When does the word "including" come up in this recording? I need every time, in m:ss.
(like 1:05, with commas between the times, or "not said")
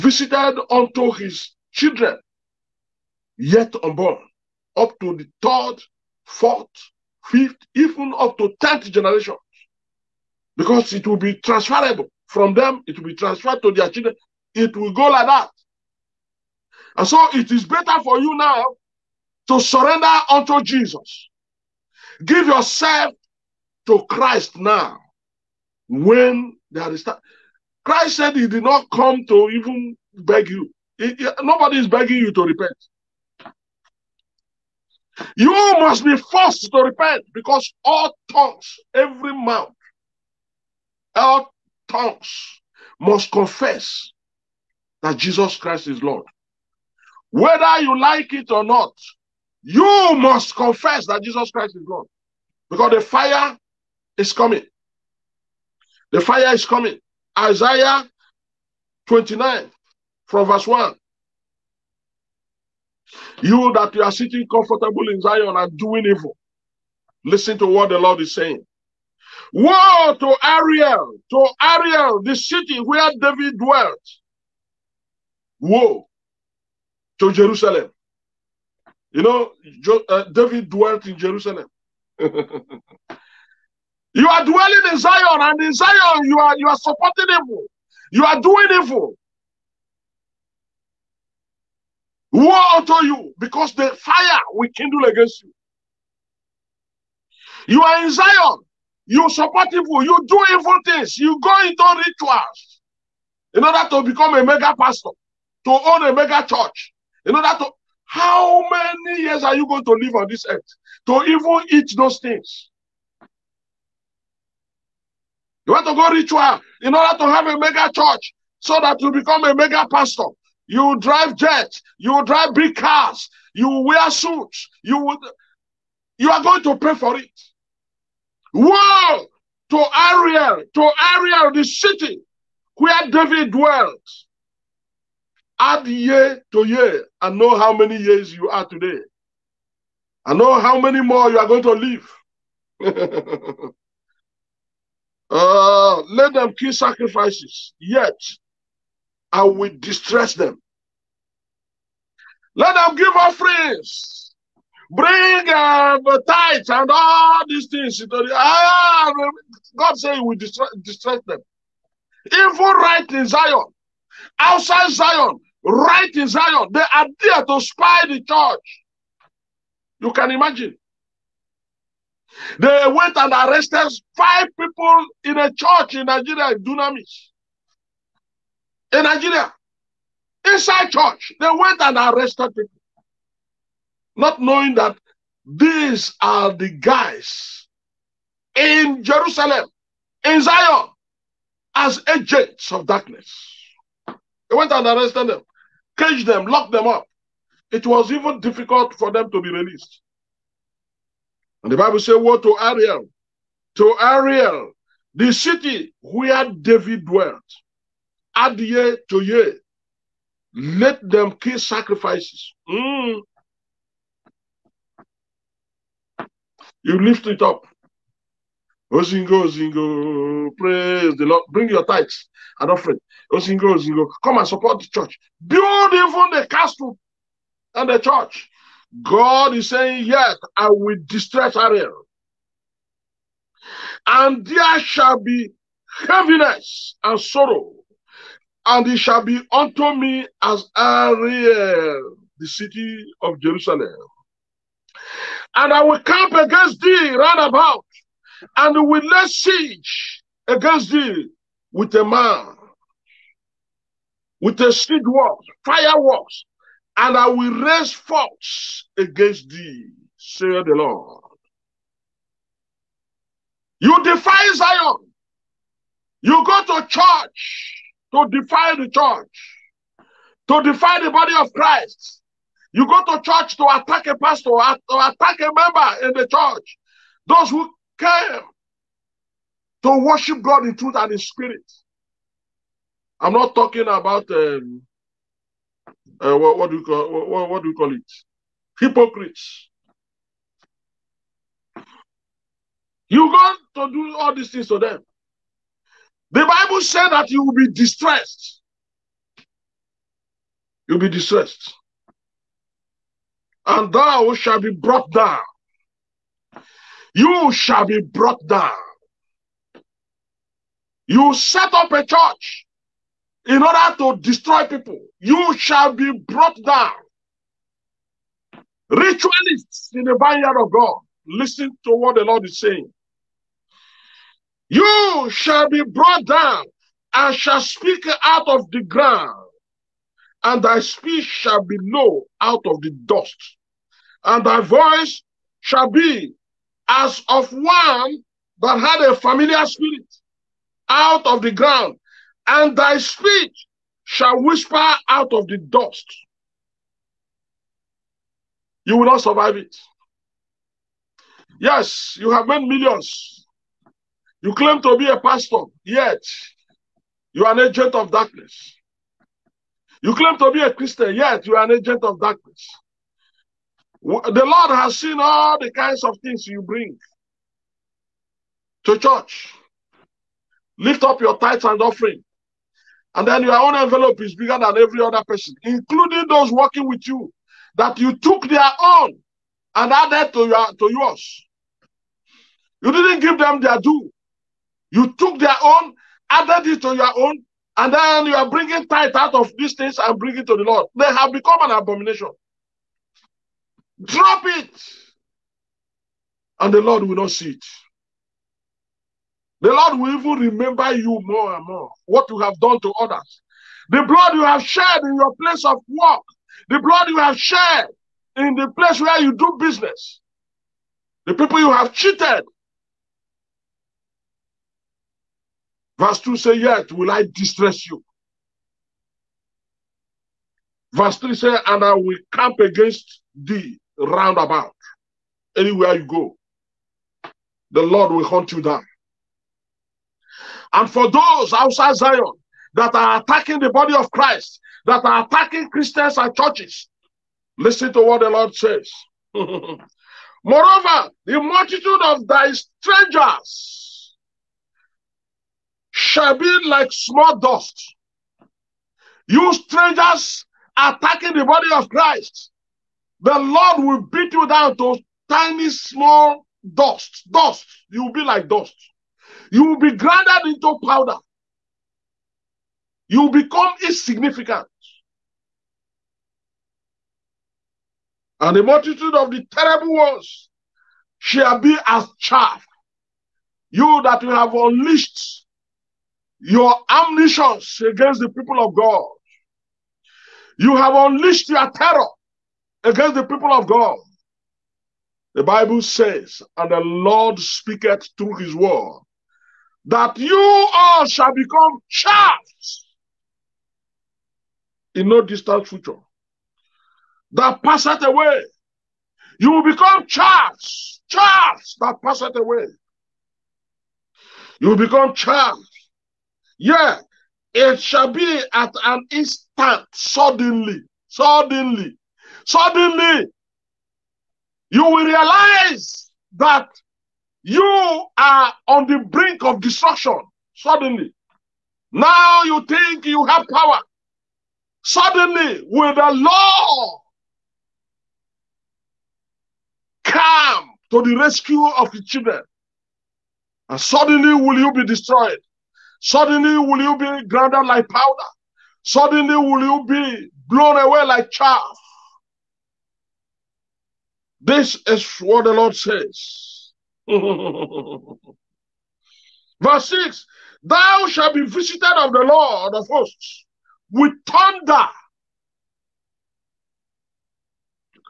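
6:15.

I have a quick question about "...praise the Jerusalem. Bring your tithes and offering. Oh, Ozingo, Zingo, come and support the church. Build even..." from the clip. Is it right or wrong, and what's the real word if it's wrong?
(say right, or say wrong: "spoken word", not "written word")
wrong: "Lord", not "Jerusalem".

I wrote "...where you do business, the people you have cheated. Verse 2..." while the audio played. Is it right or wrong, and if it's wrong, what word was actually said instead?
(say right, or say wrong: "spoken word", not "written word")
right.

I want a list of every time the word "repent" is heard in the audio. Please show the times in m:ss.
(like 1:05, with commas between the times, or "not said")
0:32, 0:36.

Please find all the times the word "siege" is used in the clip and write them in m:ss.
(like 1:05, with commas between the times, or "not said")
4:09, 4:14.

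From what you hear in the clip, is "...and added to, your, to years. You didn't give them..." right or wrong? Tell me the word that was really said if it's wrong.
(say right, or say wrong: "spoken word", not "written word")
wrong: "yours", not "years".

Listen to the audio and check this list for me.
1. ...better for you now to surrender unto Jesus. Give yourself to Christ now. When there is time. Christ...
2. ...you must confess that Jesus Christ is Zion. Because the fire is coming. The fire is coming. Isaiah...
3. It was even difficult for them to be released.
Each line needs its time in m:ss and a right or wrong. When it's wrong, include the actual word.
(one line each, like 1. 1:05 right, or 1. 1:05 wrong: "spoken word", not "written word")
1. 0:17 right
2. 0:49 wrong: "Lord", not "Zion"
3. 3:17 right.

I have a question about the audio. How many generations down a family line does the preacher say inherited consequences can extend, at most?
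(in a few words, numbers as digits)
tenth.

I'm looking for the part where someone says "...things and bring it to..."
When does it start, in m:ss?
6:29.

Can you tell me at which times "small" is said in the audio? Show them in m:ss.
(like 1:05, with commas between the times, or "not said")
7:26, 7:35.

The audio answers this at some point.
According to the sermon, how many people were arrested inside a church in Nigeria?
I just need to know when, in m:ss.
2:54.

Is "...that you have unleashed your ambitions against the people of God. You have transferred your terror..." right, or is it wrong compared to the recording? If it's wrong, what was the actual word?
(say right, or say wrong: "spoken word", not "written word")
wrong: "unleashed", not "transferred".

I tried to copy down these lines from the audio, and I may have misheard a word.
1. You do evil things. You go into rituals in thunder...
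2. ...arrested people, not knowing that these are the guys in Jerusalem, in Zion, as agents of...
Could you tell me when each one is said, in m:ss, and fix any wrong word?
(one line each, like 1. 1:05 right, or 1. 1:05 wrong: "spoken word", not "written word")
1. 1:40 wrong: "order", not "thunder"
2. 3:01 right.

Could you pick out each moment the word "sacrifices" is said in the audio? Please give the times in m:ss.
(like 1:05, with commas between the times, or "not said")
2:26, 3:31.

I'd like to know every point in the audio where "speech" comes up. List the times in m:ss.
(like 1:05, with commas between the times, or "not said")
5:30, 5:42.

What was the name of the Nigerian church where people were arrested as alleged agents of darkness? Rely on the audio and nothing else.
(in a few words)
Dunamis.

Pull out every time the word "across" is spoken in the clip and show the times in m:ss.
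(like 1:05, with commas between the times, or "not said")
not said.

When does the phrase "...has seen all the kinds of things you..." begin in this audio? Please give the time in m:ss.
6:04.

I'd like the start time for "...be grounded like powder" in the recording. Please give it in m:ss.
8:56.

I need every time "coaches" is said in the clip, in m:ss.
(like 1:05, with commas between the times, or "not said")
not said.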